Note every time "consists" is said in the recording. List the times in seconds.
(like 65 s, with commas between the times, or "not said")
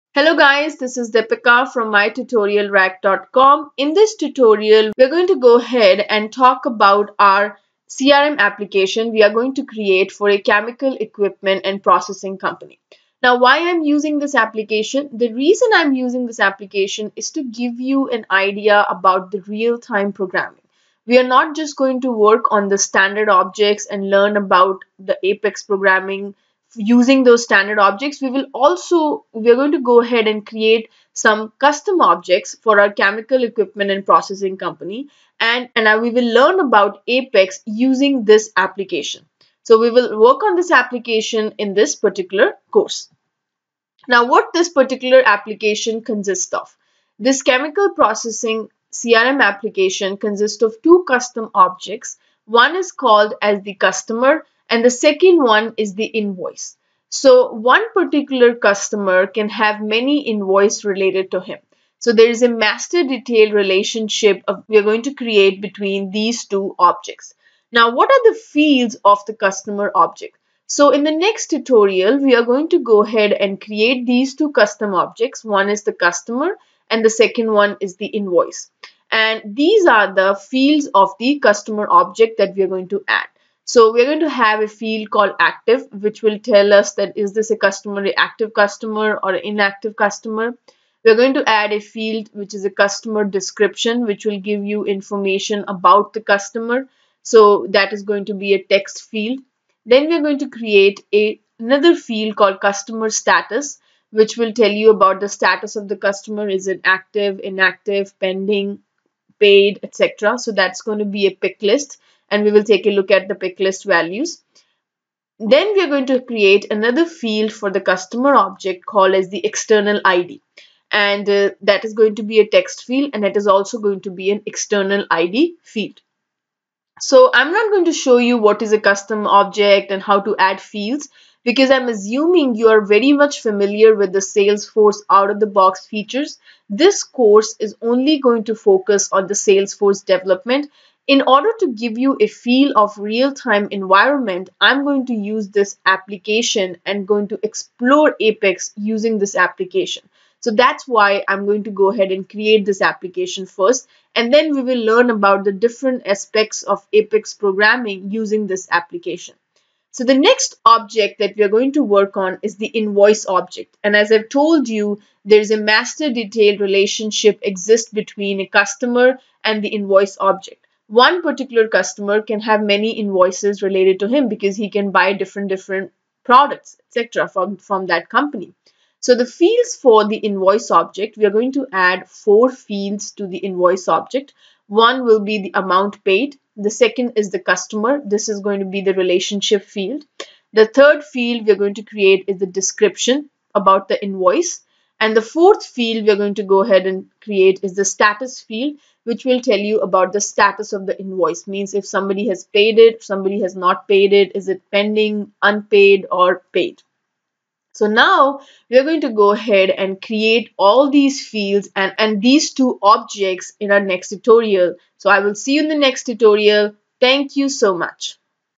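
46 s, 50 s.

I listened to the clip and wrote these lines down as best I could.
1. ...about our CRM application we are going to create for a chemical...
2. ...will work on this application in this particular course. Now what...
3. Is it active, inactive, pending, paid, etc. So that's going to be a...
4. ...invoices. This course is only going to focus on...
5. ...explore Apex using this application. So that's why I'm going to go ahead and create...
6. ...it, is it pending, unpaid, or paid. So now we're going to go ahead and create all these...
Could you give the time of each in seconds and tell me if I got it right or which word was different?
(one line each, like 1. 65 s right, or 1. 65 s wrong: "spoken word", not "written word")
1. 6 s right
2. 39 s right
3. 106 s right
4. 135 s wrong: "features", not "invoices"
5. 147 s right
6. 204 s right.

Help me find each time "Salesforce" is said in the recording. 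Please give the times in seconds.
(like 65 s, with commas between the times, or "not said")
134 s, 139 s.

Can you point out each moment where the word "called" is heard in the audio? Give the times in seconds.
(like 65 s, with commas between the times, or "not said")
52 s, 85 s, 102 s, 118 s.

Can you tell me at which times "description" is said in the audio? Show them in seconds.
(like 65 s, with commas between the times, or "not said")
93 s, 192 s.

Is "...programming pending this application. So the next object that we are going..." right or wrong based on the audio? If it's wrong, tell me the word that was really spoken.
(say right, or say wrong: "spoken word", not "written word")
wrong: "using", not "pending".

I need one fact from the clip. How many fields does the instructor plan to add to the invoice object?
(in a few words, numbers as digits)
4.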